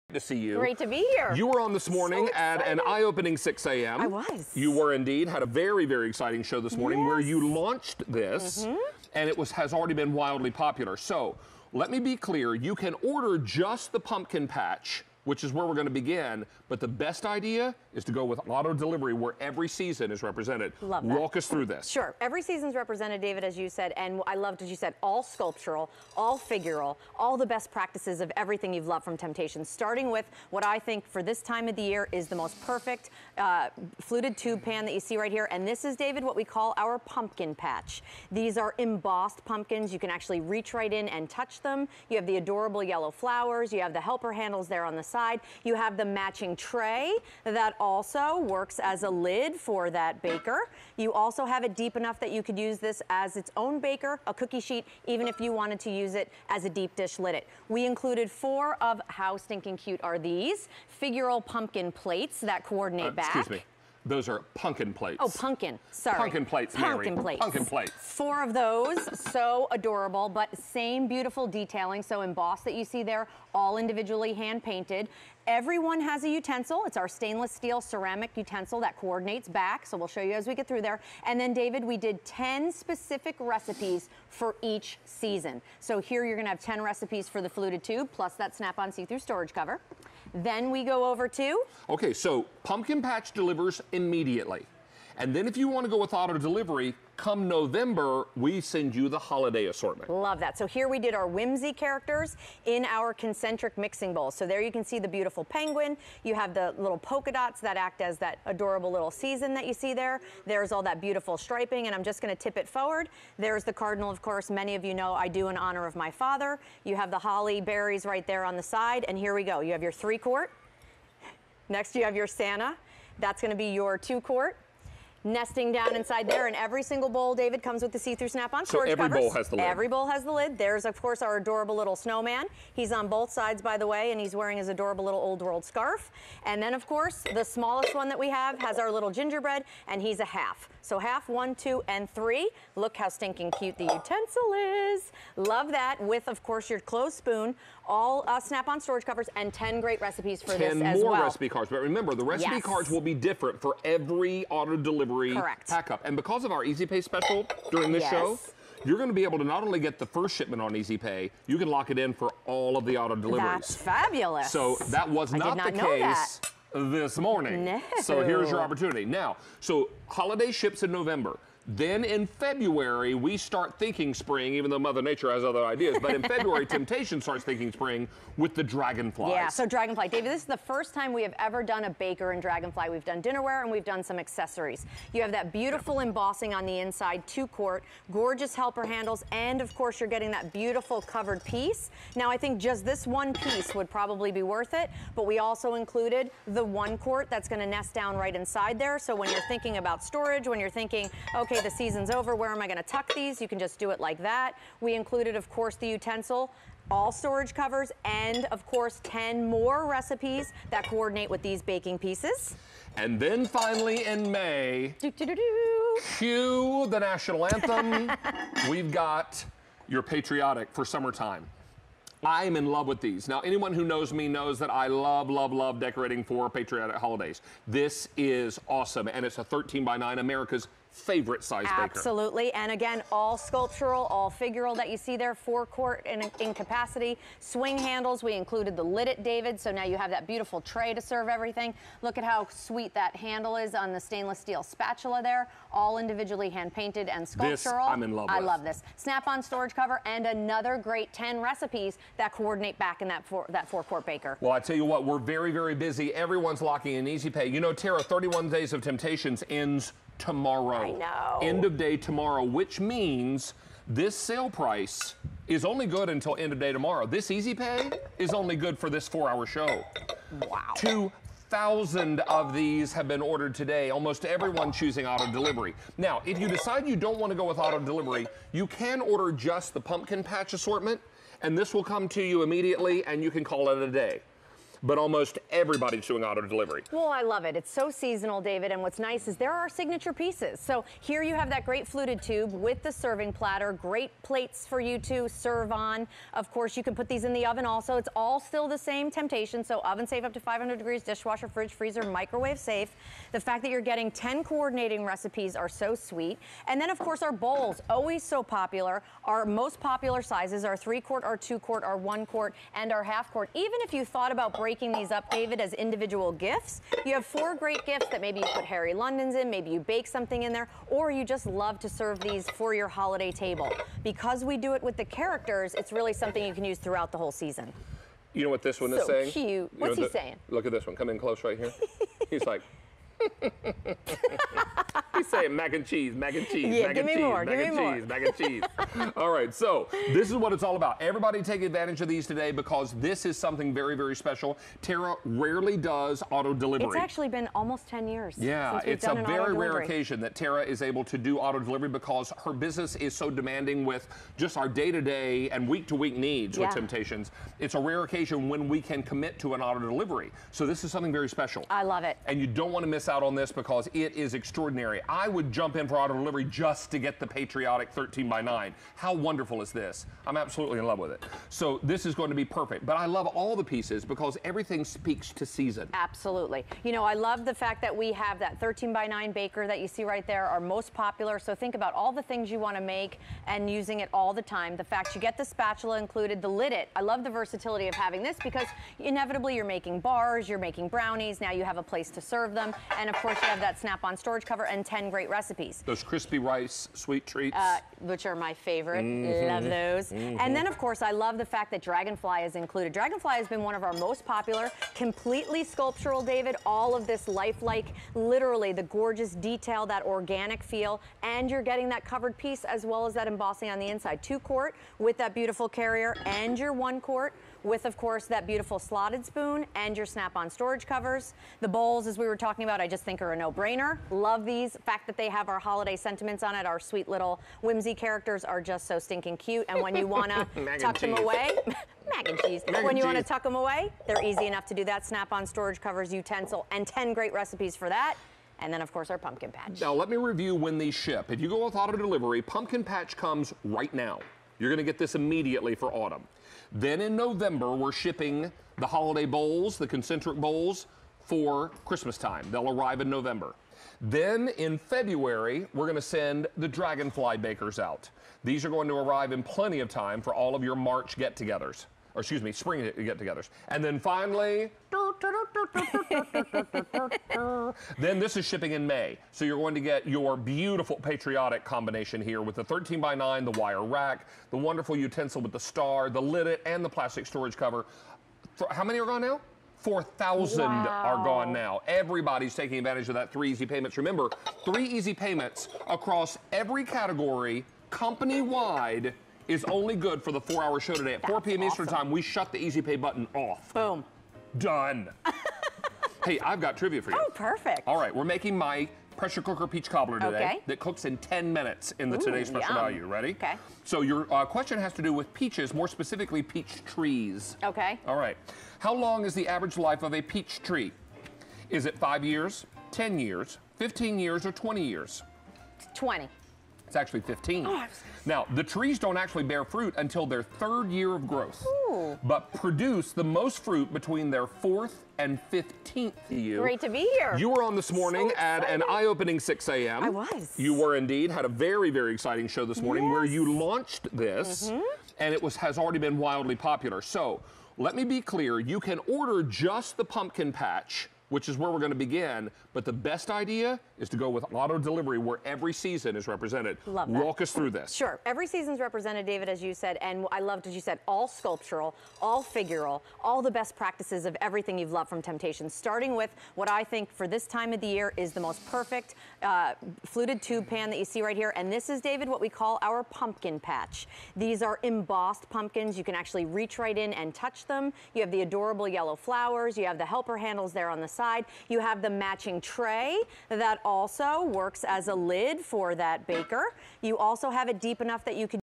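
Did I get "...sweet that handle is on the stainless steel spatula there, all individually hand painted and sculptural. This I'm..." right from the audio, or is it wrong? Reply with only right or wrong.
right.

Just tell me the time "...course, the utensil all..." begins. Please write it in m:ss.
3:25.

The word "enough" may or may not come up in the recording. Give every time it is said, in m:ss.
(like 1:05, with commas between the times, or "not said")
0:51, 7:14, 9:38.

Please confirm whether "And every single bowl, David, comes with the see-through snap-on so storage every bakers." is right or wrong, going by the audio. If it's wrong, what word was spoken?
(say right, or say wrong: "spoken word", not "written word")
wrong: "covers", not "bakers".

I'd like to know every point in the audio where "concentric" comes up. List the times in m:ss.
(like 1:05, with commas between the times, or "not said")
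1:43, 7:29.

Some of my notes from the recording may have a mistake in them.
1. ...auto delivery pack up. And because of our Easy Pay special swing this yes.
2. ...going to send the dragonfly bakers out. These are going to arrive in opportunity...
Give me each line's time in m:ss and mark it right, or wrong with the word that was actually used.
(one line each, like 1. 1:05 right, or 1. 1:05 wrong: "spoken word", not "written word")
1. 2:34 wrong: "during", not "swing"
2. 7:35 wrong: "plenty", not "opportunity".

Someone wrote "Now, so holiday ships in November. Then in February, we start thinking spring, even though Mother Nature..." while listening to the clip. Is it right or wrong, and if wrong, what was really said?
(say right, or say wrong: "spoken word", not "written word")
right.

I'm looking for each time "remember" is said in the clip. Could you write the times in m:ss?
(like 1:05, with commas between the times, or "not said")
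2:31, 8:03.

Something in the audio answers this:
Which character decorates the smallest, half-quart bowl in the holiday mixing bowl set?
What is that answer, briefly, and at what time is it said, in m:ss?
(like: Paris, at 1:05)
gingerbread, at 2:19.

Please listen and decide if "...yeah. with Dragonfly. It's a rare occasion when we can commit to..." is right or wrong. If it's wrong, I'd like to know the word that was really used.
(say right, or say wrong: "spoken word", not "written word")
wrong: "Temptations", not "Dragonfly".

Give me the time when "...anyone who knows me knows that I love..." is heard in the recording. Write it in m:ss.
3:43.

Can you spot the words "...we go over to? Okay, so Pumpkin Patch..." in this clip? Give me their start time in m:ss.
1:30.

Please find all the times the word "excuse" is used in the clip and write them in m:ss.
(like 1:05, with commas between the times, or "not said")
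1:03, 7:42.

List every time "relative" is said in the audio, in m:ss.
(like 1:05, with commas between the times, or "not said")
not said.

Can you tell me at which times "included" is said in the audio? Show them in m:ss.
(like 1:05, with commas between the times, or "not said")
0:57, 3:15, 3:24, 3:58, 6:25, 6:42.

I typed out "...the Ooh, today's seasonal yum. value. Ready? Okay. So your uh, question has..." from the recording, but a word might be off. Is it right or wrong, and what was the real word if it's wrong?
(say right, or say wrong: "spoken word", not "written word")
wrong: "special", not "seasonal".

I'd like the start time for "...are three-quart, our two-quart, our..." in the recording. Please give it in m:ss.
5:10.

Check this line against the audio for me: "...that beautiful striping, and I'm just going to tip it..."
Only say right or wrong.
right.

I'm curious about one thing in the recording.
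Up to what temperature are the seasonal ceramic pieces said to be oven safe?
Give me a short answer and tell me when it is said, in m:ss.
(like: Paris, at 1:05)
500 degrees, at 5:00.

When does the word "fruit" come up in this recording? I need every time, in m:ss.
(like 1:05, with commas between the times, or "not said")
8:39, 8:43.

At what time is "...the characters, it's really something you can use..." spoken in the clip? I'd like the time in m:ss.
5:24.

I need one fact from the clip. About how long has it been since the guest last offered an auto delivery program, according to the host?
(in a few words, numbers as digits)
almost 10 years.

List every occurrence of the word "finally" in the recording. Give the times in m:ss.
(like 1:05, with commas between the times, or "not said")
3:33, 7:43.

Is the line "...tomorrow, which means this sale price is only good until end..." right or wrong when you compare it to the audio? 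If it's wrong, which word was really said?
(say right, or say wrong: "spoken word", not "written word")
right.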